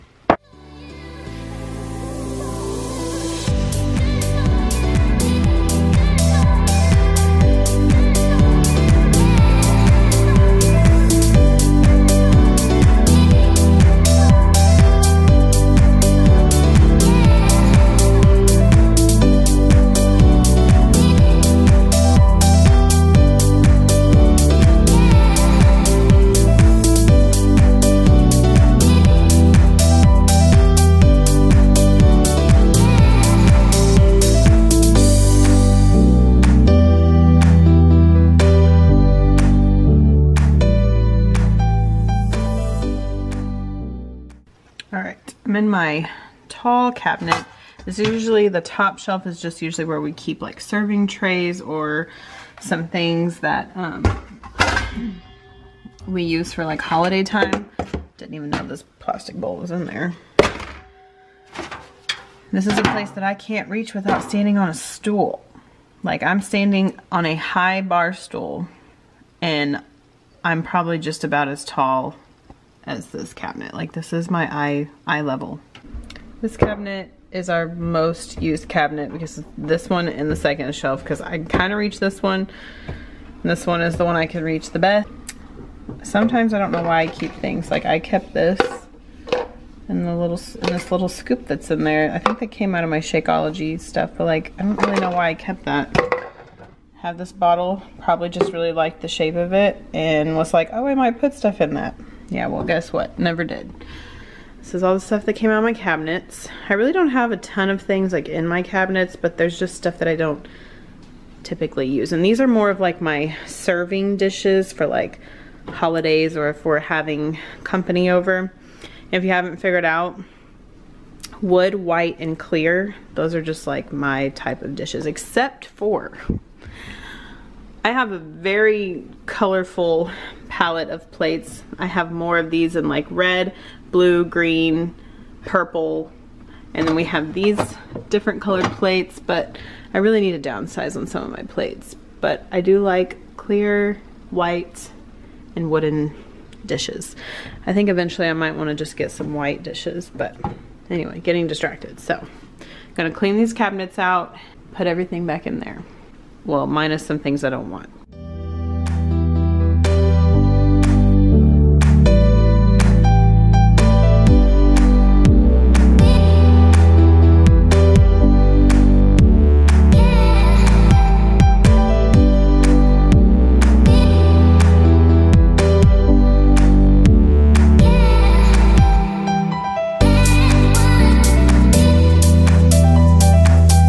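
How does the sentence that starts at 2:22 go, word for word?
But I do like clear, white, and wooden dishes.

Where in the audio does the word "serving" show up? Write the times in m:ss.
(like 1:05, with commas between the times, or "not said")
0:50, 1:53.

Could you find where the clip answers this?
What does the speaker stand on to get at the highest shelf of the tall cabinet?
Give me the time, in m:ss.
1:07.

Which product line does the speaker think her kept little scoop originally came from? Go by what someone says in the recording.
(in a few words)
Shakeology.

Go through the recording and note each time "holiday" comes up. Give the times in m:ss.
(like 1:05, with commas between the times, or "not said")
0:56, 1:55.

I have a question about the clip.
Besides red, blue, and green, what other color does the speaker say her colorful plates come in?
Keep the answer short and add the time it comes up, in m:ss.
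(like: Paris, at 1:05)
Purple, at 2:15.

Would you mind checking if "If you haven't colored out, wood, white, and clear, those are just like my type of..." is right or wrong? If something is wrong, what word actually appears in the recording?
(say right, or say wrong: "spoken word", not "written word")
wrong: "figured", not "colored".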